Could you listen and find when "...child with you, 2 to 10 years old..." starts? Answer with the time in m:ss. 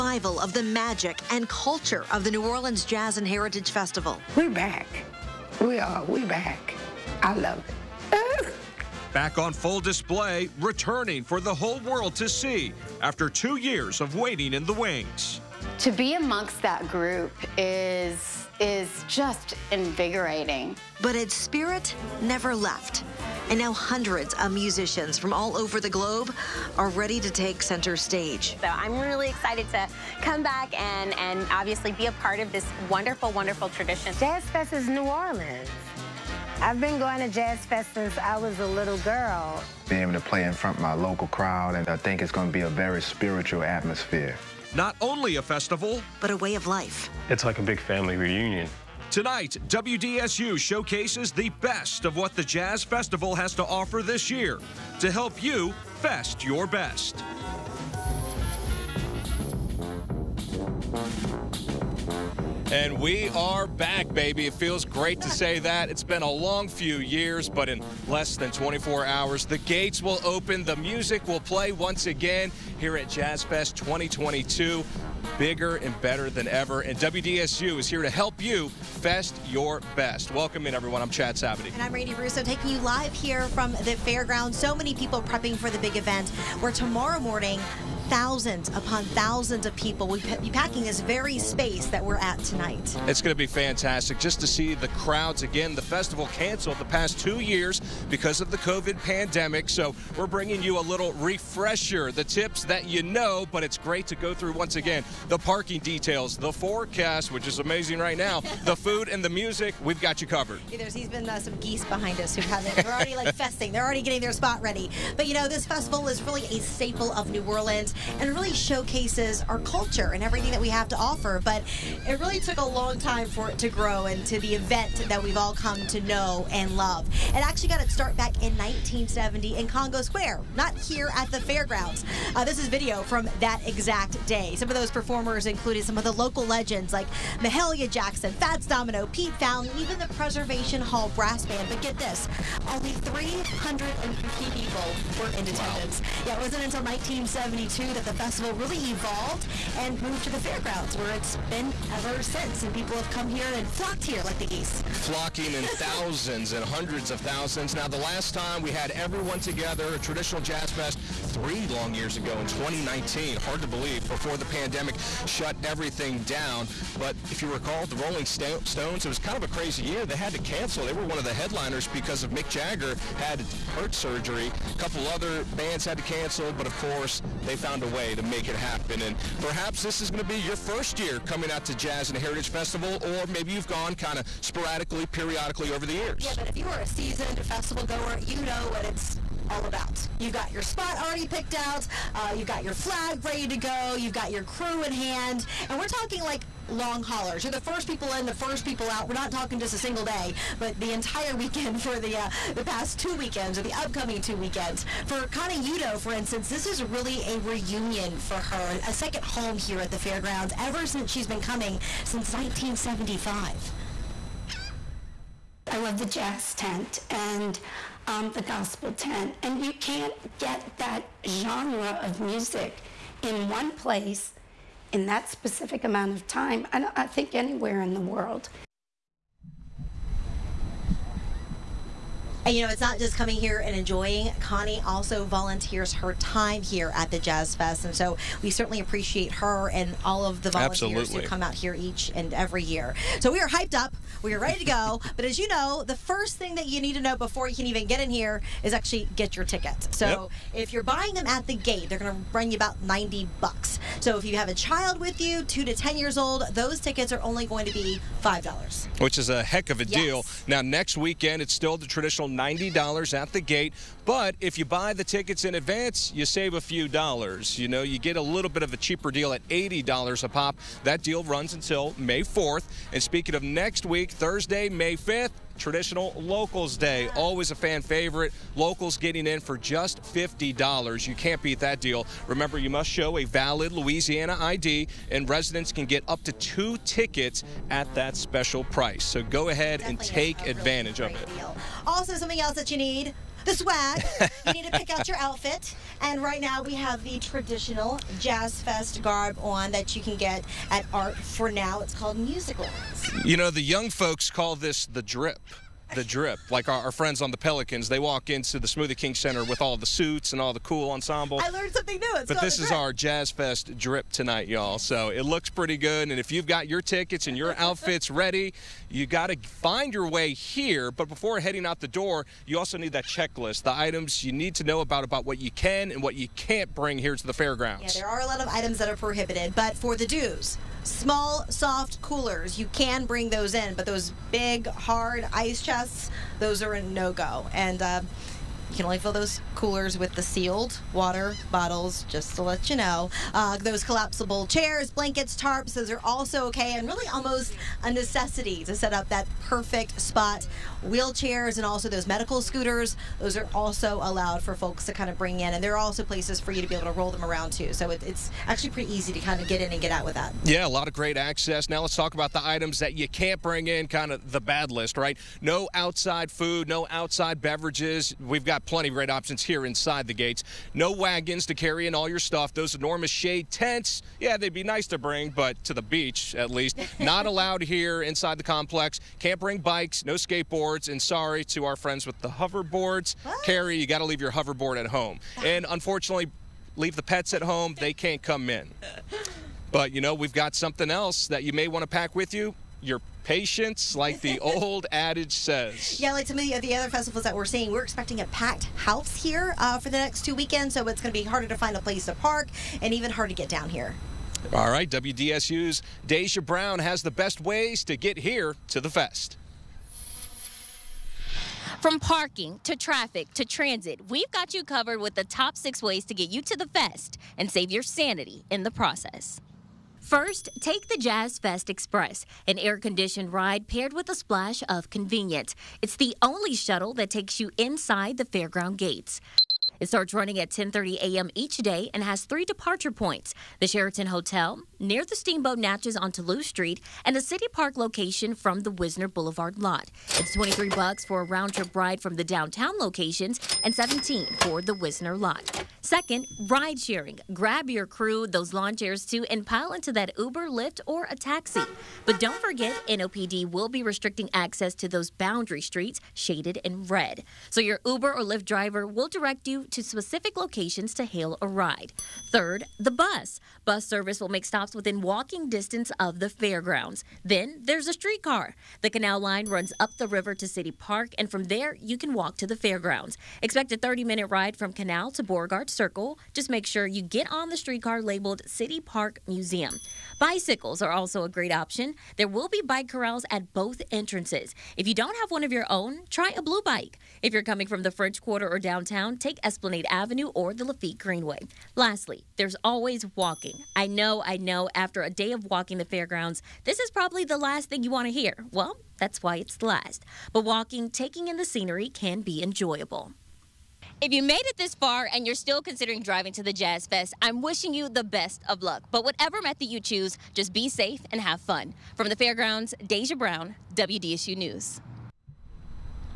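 4:14.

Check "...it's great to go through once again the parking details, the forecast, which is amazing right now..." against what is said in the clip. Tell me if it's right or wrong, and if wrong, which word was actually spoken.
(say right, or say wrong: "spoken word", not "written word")
right.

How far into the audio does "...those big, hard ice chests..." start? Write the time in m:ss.
5:33.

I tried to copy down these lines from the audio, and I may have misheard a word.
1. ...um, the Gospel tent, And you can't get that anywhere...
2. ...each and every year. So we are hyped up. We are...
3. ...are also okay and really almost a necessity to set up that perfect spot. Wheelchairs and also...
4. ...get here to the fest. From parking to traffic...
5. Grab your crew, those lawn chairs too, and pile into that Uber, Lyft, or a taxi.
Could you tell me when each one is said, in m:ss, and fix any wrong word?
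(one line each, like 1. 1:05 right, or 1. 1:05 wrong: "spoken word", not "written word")
1. 3:38 wrong: "genre", not "anywhere"
2. 4:01 right
3. 5:45 right
4. 6:47 right
5. 7:27 right.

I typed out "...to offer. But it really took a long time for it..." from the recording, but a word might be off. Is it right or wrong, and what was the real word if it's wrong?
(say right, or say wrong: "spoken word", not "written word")
right.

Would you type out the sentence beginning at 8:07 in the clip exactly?
If you're coming from the French Quarter or downtown, take as Esplanade Avenue or the Lafitte Greenway.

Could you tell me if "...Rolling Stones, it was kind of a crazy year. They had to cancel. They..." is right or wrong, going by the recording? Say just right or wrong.
right.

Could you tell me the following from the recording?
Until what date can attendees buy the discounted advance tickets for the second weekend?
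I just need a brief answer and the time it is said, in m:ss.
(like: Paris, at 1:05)
May 4th, at 4:31.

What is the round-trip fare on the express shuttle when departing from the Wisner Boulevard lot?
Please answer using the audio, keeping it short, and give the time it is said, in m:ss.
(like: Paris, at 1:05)
$17, at 7:23.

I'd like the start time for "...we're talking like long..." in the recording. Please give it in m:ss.
3:15.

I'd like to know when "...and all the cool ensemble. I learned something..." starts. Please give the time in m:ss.
5:10.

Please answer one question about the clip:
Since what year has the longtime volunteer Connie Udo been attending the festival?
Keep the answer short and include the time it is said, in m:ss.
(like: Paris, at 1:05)
1975, at 3:32.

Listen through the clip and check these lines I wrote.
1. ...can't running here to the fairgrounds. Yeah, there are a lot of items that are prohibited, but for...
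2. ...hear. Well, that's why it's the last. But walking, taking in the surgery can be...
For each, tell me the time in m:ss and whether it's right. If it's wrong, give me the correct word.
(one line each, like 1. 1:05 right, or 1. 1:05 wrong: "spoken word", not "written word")
1. 5:26 wrong: "bring", not "running"
2. 8:18 wrong: "scenery", not "surgery".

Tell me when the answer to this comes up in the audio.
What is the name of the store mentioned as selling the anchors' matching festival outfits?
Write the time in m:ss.
5:00.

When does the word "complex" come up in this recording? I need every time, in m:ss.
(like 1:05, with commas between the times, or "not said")
6:18.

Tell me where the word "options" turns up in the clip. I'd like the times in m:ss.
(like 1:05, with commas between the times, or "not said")
6:09, 8:01.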